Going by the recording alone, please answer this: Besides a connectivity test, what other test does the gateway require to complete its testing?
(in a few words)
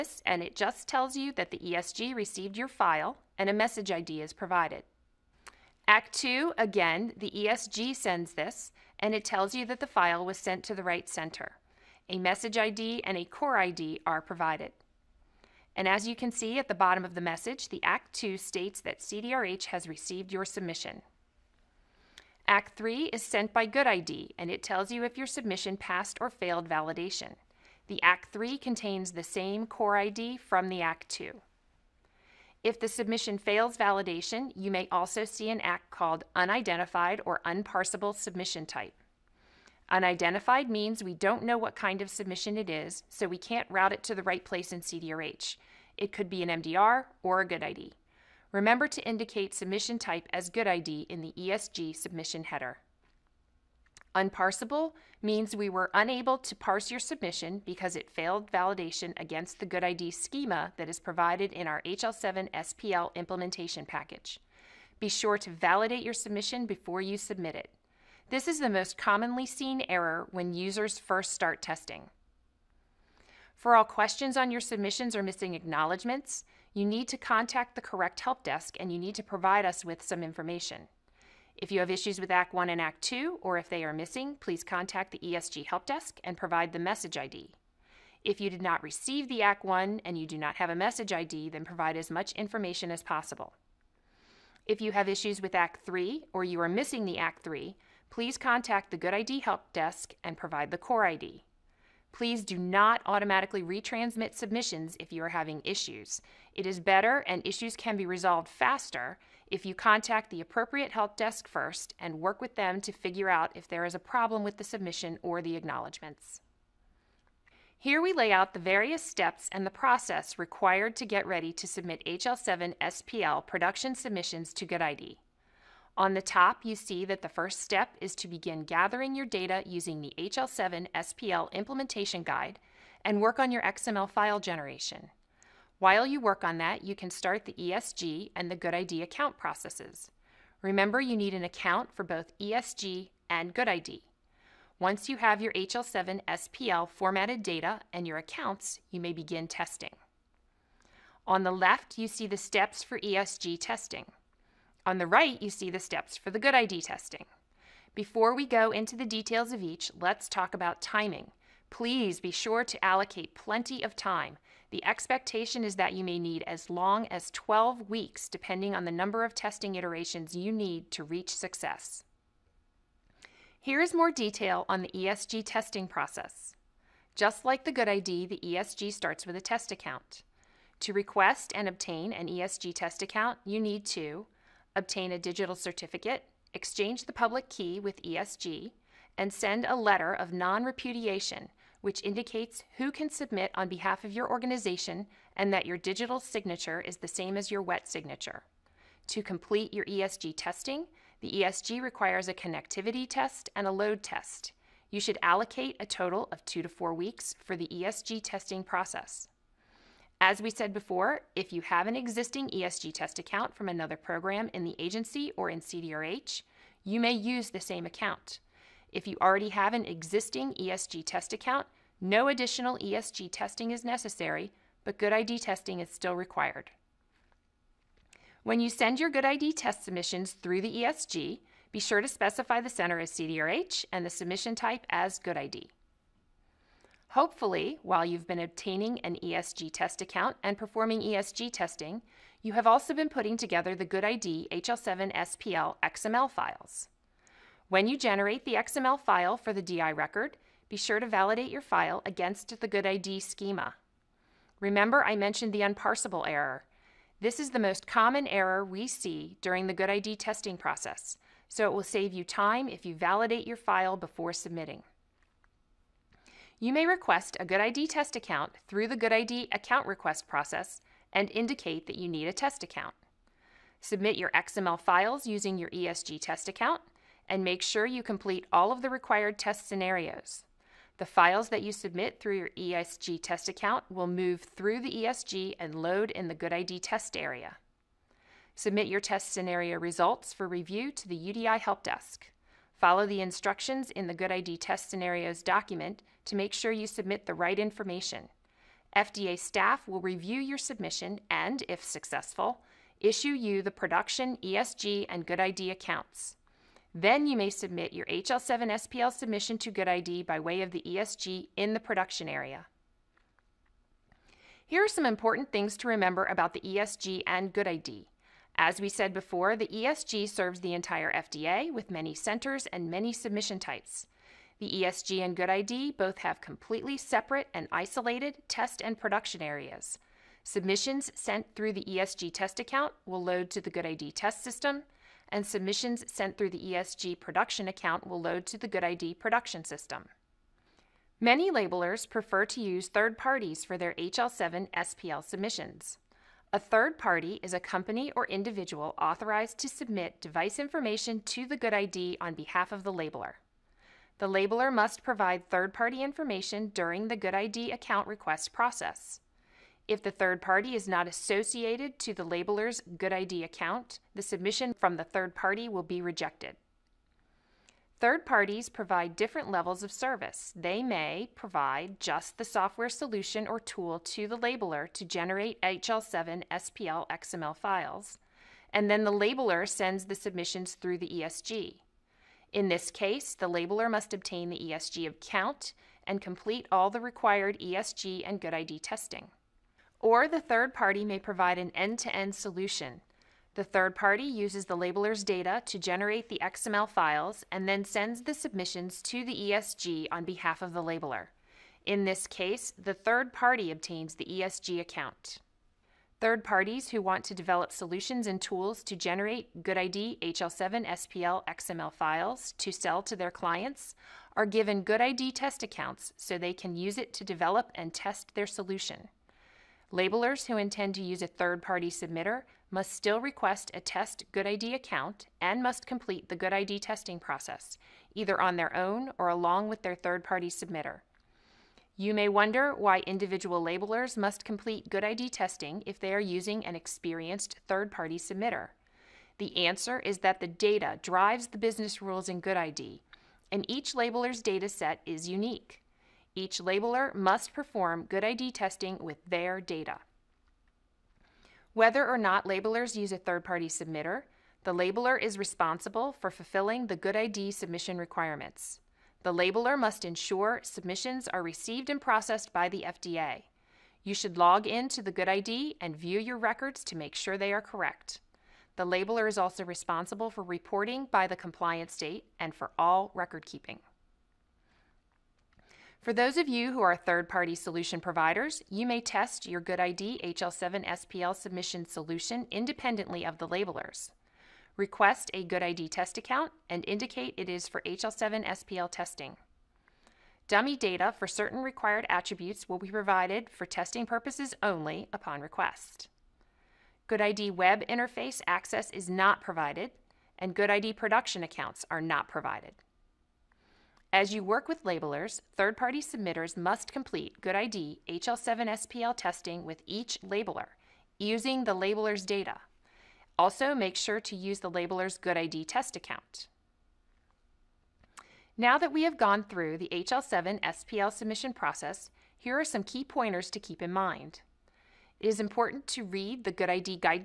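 Load test.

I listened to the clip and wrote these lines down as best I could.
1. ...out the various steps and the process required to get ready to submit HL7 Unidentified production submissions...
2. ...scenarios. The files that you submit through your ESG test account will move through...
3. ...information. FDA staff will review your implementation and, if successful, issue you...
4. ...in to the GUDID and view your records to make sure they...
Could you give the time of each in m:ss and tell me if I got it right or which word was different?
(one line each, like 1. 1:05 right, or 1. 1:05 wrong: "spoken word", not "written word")
1. 1:58 wrong: "SPL", not "Unidentified"
2. 4:39 right
3. 4:57 wrong: "submission", not "implementation"
4. 7:44 right.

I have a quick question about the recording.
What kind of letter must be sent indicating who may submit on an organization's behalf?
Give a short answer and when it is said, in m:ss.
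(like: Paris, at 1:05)
Letter of non repudiation, at 3:09.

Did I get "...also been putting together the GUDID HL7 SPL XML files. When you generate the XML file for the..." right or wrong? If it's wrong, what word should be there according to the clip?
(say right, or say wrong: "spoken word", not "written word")
right.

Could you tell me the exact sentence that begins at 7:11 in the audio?
You may wonder why individual labelers must complete GUDID testing if they are using an experienced third-party submitter.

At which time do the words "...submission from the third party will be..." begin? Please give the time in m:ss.
6:04.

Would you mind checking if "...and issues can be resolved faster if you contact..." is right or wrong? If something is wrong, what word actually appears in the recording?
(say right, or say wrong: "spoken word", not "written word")
right.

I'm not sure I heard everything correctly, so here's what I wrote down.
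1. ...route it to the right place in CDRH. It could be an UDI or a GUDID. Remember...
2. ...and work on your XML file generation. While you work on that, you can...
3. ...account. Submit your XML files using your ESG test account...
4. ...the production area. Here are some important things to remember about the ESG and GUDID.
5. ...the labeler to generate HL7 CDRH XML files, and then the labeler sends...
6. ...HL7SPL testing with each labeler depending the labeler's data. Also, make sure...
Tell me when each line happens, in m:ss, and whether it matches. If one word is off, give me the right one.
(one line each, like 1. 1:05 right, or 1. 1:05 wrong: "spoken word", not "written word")
1. 0:43 wrong: "MDR", not "UDI"
2. 2:13 right
3. 4:32 right
4. 5:11 right
5. 6:14 wrong: "SPL", not "CDRH"
6. 8:28 wrong: "using", not "depending".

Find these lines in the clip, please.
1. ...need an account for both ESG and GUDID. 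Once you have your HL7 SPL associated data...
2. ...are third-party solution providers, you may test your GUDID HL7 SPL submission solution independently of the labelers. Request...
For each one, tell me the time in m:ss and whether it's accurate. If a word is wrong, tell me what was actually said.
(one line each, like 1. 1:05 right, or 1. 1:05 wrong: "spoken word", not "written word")
1. 2:21 wrong: "formatted", not "associated"
2. 7:56 right.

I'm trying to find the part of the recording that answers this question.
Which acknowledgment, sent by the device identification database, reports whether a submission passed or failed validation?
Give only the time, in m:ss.
0:22.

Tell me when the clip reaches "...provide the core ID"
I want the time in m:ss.
1:40.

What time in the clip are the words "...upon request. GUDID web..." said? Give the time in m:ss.
8:15.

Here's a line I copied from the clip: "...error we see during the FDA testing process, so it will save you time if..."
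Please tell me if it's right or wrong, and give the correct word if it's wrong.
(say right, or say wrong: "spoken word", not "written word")
wrong: "GUDID", not "FDA".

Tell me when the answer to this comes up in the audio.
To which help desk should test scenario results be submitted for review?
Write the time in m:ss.
4:51.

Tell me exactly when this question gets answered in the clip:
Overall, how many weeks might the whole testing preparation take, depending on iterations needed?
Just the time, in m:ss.
2:47.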